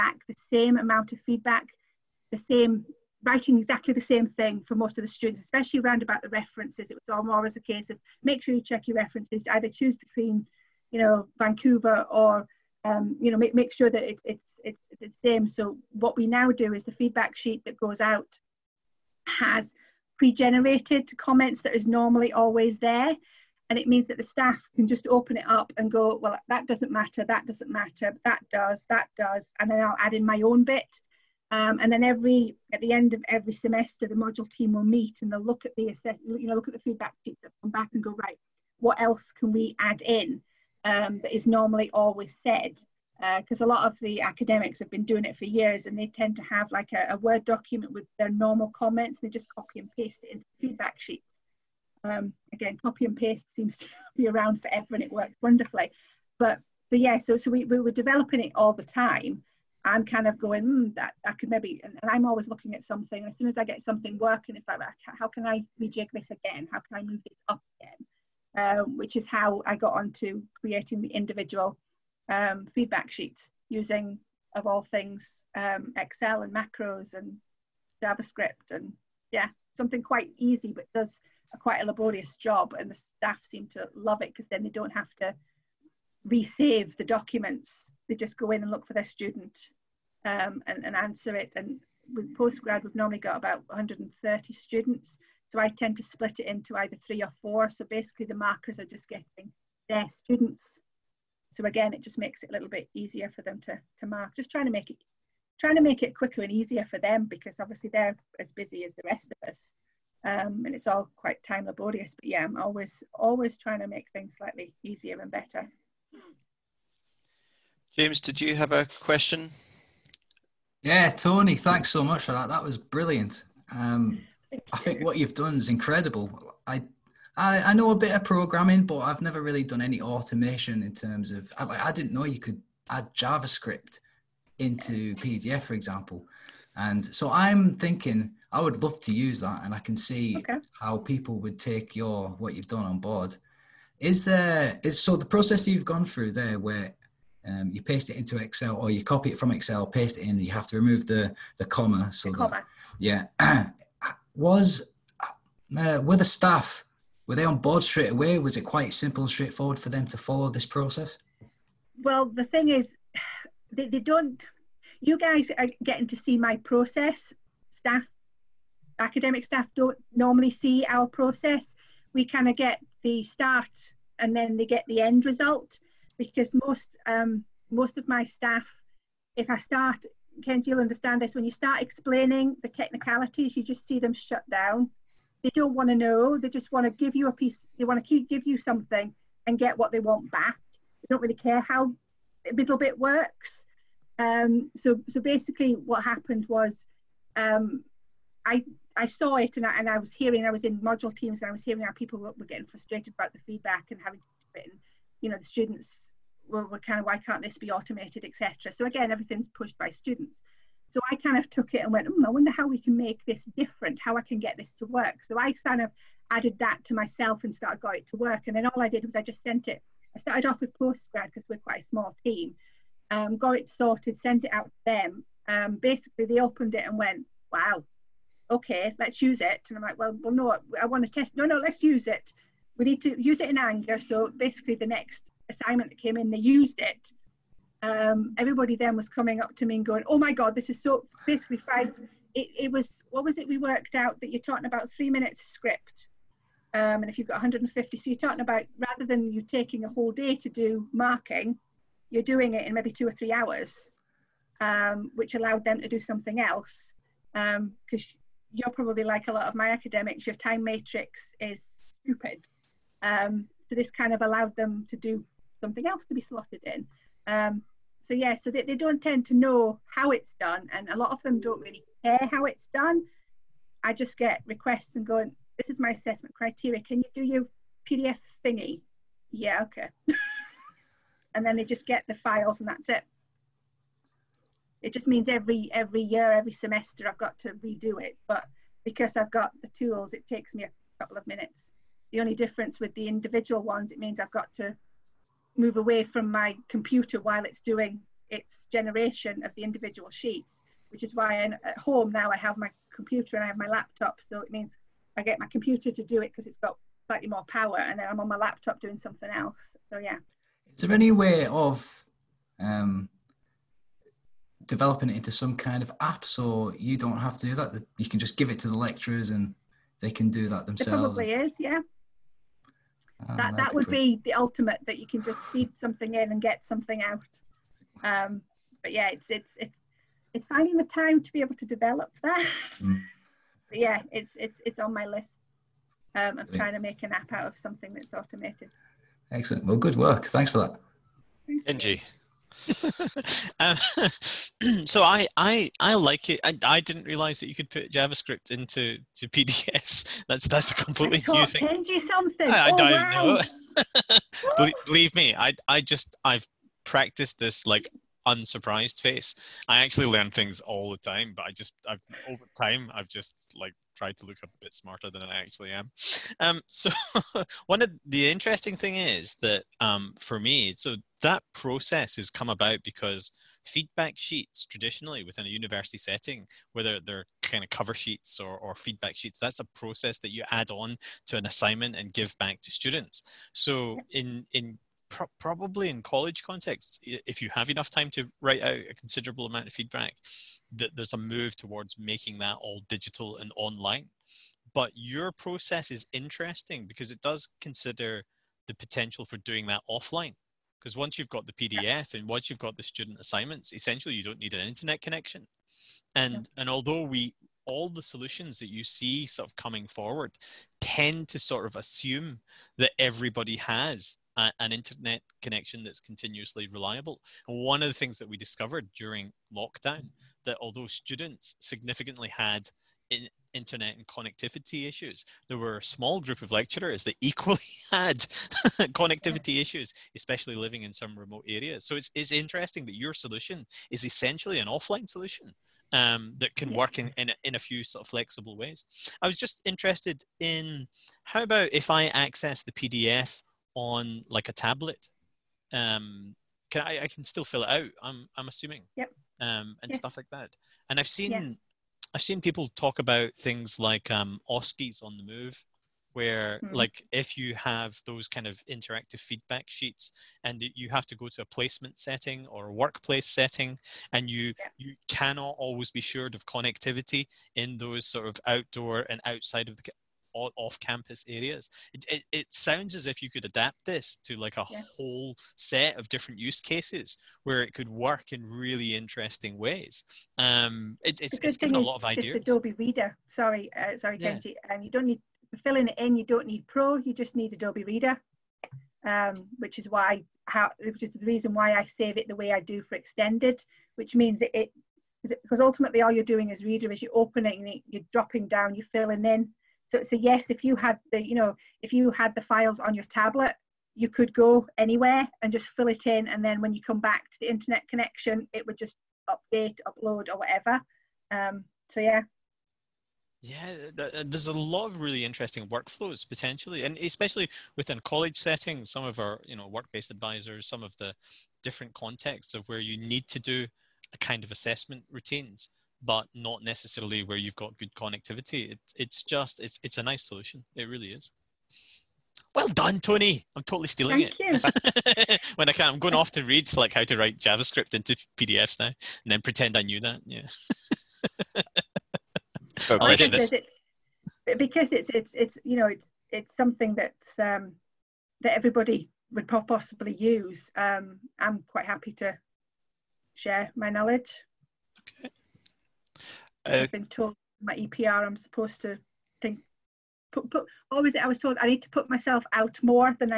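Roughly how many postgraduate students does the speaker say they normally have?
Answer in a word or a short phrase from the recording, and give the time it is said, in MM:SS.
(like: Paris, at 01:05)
130, at 01:33.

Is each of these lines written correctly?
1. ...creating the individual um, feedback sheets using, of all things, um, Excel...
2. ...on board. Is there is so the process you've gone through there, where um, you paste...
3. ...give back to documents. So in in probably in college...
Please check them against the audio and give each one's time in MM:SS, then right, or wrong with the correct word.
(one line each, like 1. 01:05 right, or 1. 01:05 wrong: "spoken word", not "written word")
1. 01:10 right
2. 02:22 right
3. 06:22 wrong: "students", not "documents".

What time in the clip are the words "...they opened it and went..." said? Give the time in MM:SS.
03:46.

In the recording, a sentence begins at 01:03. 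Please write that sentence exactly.
As soon as I get something working, it's like, how can I rejig this again?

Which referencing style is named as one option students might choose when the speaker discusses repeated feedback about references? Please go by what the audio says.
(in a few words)
Vancouver.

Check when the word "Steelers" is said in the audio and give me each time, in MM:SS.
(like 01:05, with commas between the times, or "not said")
not said.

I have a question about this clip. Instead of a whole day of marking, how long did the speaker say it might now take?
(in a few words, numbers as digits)
2 or 3 hours.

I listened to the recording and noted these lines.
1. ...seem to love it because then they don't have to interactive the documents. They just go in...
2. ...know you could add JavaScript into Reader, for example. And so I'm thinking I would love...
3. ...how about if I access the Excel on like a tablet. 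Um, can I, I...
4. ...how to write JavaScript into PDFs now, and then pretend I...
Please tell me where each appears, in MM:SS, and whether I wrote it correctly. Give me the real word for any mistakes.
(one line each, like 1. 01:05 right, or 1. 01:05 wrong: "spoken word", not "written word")
1. 01:23 wrong: "resave", not "interactive"
2. 02:12 wrong: "PDF", not "Reader"
3. 07:21 wrong: "PDF", not "Excel"
4. 08:56 right.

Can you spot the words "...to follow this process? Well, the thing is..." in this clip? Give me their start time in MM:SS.
02:40.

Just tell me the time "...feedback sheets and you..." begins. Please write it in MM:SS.
07:39.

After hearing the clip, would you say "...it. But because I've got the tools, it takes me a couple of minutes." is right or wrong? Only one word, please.
right.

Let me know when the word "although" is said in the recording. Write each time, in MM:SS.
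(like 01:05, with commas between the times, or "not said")
06:46, 07:00.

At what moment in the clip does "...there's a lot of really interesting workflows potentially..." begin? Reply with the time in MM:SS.
08:34.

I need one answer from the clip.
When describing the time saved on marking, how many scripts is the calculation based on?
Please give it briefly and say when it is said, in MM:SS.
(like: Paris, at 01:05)
150, at 04:07.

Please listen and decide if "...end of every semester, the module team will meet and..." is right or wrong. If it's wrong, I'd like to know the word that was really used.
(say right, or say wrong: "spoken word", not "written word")
right.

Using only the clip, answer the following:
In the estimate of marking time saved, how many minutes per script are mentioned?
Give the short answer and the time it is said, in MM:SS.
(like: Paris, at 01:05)
3, at 04:04.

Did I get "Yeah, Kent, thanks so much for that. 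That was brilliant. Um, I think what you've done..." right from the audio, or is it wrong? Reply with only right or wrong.
wrong.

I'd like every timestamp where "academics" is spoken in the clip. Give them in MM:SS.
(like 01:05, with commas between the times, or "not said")
00:44, 02:48, 04:19.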